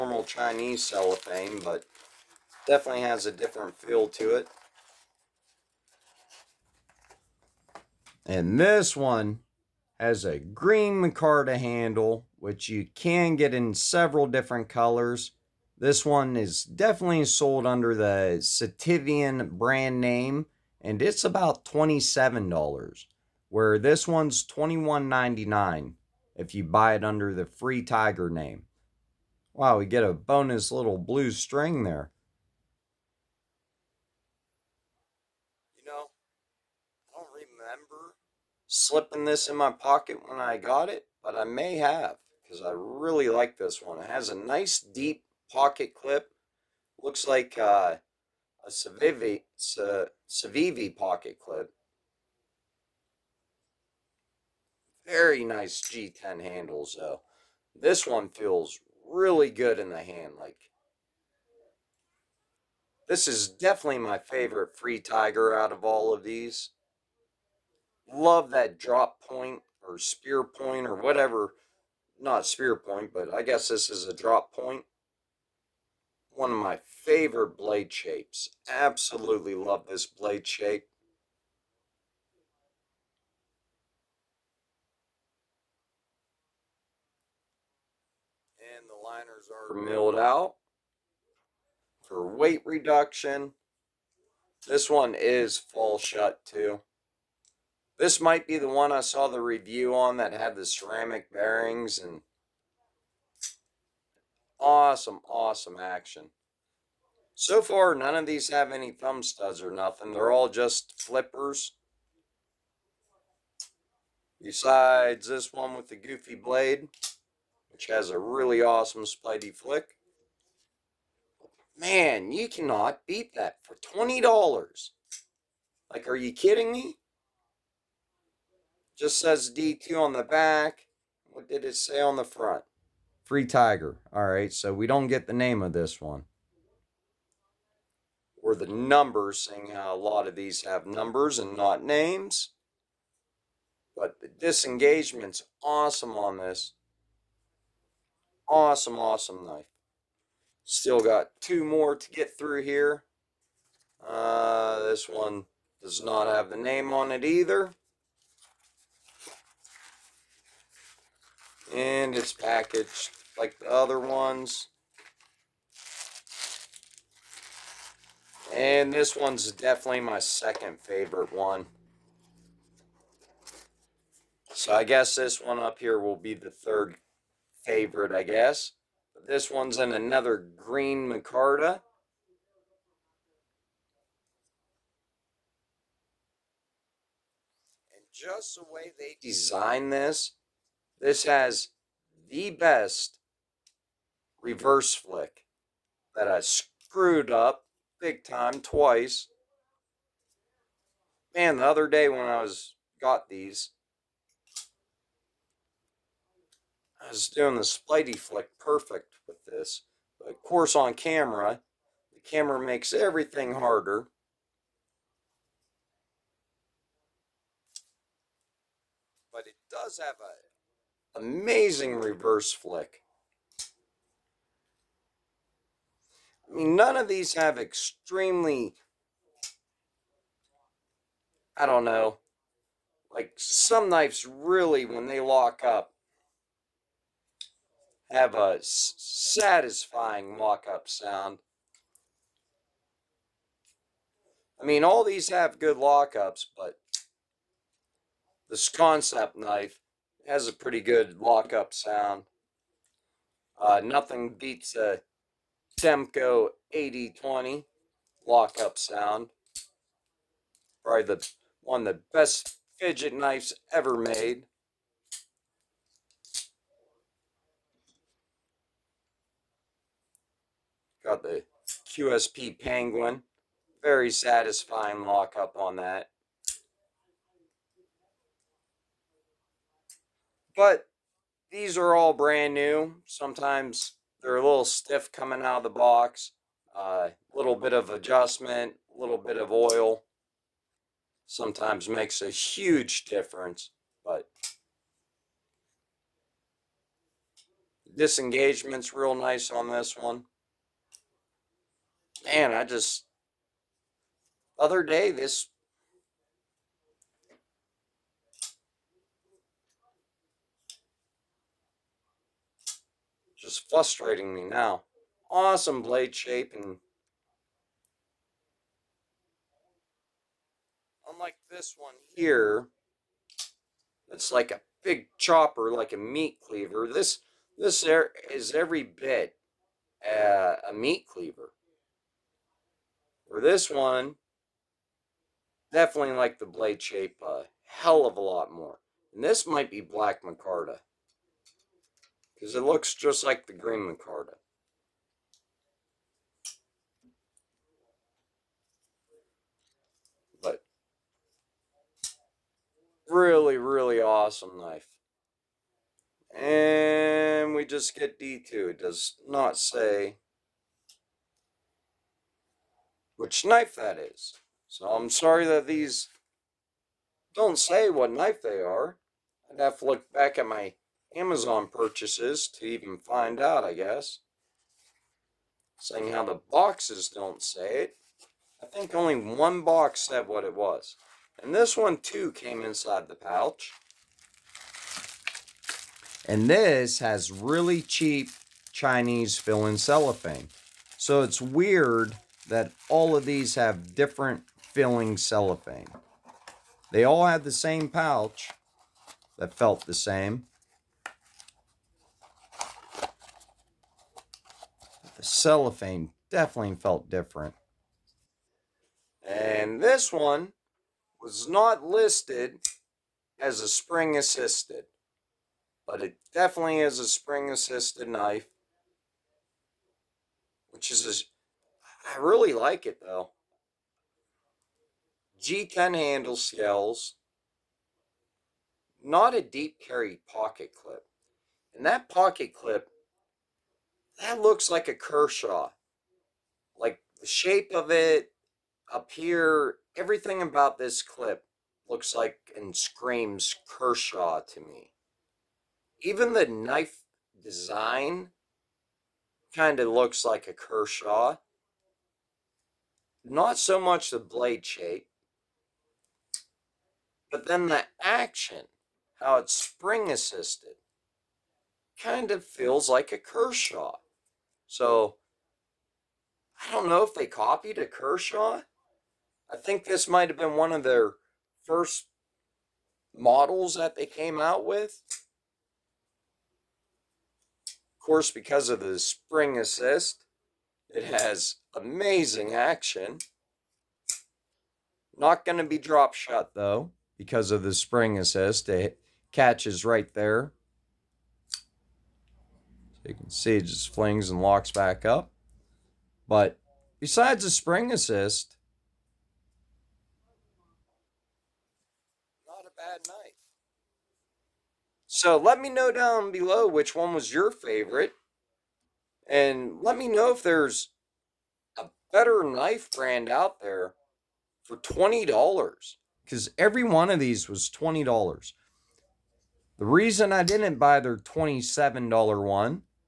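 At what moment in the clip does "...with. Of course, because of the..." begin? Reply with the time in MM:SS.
07:54.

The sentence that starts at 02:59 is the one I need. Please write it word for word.
But this one's in another green micarta.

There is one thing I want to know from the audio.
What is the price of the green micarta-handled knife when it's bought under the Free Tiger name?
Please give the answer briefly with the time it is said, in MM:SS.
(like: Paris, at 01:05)
$21.99, at 00:24.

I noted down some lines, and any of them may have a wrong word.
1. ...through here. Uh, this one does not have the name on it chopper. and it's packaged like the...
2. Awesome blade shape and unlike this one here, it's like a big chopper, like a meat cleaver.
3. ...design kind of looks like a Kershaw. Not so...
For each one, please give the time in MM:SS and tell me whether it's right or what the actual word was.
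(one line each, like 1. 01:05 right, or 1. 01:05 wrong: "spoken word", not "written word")
1. 02:32 wrong: "either", not "chopper"
2. 05:15 right
3. 07:27 right.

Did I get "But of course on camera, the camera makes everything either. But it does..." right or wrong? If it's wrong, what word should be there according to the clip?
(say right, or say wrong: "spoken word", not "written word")
wrong: "harder", not "either".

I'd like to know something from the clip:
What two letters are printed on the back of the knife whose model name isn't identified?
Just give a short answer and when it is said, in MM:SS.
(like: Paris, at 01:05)
DQ, at 02:09.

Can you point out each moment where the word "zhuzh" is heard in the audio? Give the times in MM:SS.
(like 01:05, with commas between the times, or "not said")
not said.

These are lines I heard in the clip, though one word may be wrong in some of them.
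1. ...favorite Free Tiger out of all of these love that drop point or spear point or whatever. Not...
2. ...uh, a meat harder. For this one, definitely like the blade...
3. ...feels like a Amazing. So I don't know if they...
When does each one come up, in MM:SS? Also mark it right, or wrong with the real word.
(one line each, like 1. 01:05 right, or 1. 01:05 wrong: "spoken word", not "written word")
1. 01:04 right
2. 05:30 wrong: "cleaver", not "harder"
3. 07:42 wrong: "Kershaw", not "Amazing".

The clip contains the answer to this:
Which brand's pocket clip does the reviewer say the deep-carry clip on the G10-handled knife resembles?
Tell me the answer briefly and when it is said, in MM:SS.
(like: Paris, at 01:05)
Civivi, at 00:49.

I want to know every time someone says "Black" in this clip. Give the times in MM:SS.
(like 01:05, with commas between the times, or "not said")
05:39.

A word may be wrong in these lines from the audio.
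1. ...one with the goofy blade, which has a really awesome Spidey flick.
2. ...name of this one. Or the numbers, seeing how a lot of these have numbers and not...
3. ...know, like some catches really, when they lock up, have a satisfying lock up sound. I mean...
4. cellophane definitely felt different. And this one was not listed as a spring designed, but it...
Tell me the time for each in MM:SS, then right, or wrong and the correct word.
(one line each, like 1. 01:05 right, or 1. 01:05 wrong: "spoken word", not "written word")
1. 01:55 right
2. 02:15 right
3. 03:51 wrong: "knives", not "catches"
4. 06:45 wrong: "assisted", not "designed".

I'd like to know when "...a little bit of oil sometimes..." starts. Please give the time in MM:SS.
04:48.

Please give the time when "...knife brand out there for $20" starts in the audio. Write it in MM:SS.
08:32.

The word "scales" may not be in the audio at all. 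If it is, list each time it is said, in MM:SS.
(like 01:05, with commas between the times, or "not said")
07:06.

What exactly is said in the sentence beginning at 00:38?
slipping this in my pocket when I got it, but I may have because I really like this one.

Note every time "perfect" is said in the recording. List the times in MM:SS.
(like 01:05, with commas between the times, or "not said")
03:28.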